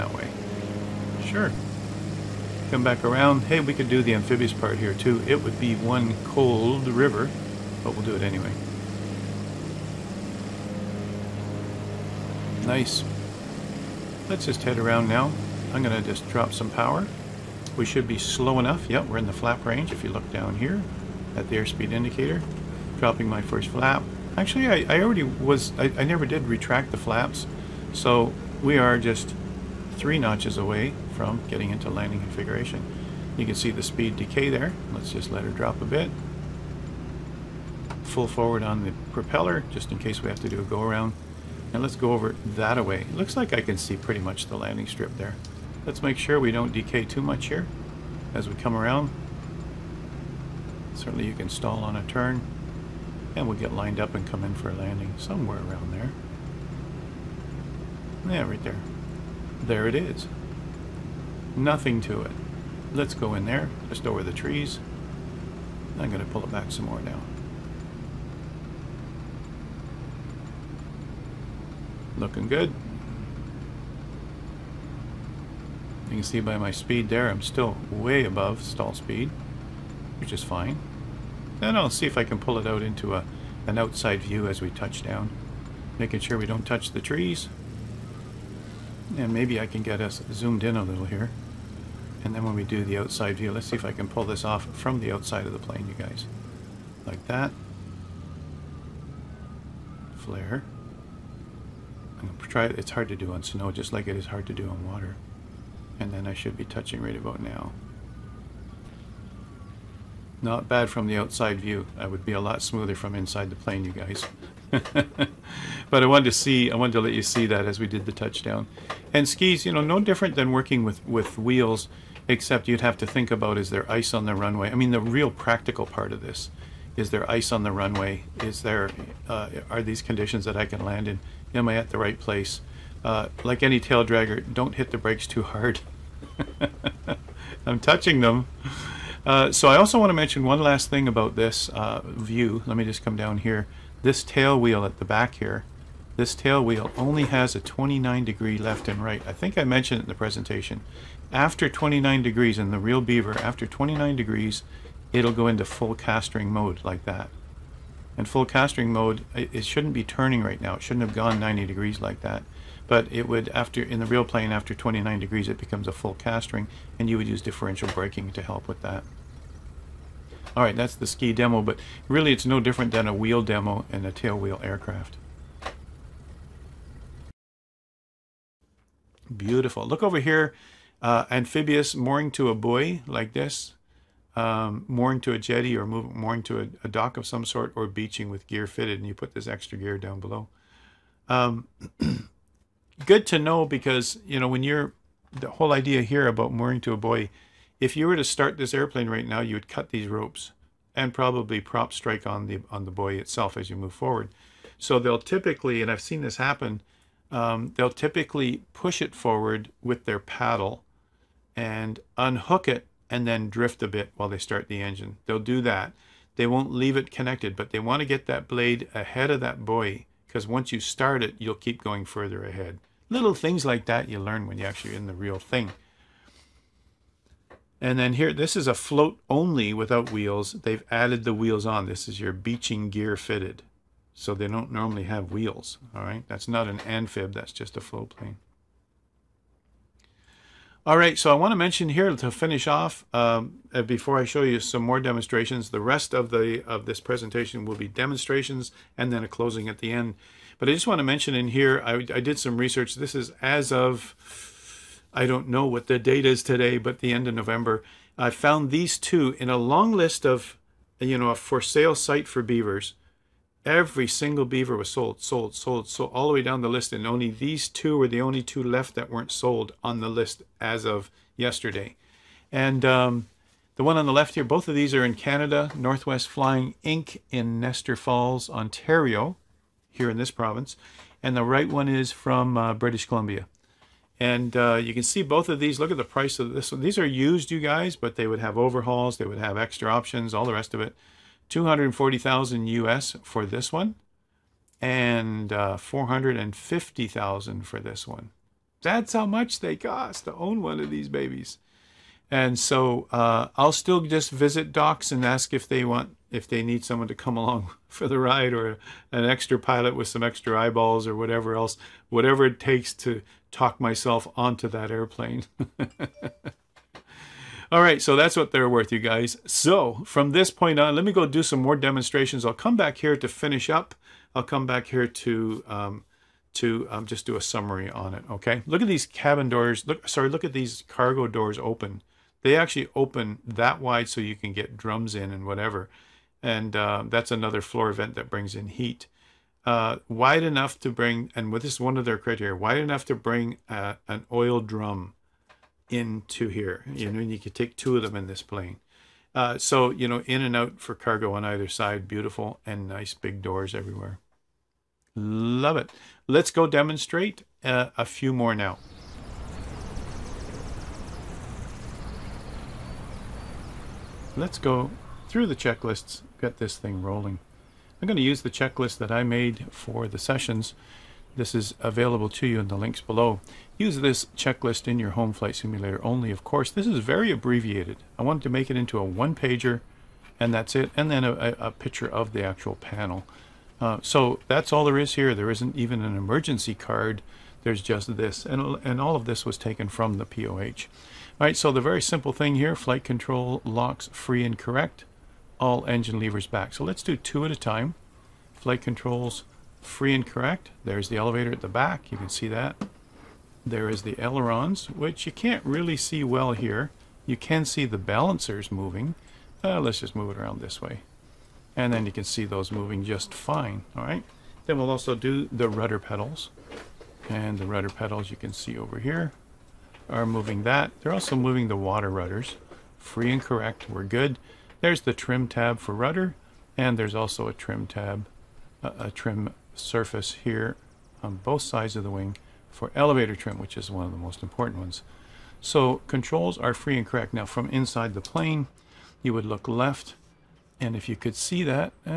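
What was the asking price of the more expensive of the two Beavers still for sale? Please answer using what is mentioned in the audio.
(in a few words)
450,000.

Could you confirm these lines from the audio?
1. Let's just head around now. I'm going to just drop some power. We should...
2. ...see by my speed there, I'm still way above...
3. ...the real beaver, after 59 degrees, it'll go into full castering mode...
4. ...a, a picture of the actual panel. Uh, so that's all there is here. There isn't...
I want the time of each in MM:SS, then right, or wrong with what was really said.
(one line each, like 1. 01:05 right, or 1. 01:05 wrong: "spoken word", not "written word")
1. 00:14 right
2. 01:16 right
3. 02:32 wrong: "29", not "59"
4. 06:21 right.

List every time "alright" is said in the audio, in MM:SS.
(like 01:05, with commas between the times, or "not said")
06:31, 06:53.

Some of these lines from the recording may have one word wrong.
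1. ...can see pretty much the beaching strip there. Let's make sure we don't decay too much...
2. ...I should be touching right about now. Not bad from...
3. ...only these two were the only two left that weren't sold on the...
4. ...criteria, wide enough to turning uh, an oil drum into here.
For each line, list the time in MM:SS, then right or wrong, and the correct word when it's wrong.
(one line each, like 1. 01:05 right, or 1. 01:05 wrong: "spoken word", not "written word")
1. 00:43 wrong: "landing", not "beaching"
2. 01:46 right
3. 04:27 right
4. 05:42 wrong: "bring", not "turning".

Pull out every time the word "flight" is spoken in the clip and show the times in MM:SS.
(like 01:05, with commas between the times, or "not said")
06:15, 06:32, 06:38.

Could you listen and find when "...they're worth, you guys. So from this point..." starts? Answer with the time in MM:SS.
05:18.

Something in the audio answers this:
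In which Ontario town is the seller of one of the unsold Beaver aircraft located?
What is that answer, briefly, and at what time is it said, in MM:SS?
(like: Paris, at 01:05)
Nestor Falls, at 04:37.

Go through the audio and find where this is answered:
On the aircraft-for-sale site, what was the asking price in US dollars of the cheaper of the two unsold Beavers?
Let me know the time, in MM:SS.
04:51.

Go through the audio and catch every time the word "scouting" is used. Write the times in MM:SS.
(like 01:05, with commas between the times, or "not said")
not said.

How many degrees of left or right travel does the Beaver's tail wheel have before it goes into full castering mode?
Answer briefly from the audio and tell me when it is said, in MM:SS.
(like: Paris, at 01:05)
29 degrees, at 02:27.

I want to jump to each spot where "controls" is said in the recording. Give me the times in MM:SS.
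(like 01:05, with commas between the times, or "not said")
06:33, 06:38, 07:16.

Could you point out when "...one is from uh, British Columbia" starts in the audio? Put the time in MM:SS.
04:41.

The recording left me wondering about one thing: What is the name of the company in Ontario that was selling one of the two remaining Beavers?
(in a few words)
Northwest Flying Inc.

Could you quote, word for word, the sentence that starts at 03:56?
That's not an amphib, that's just a float plane.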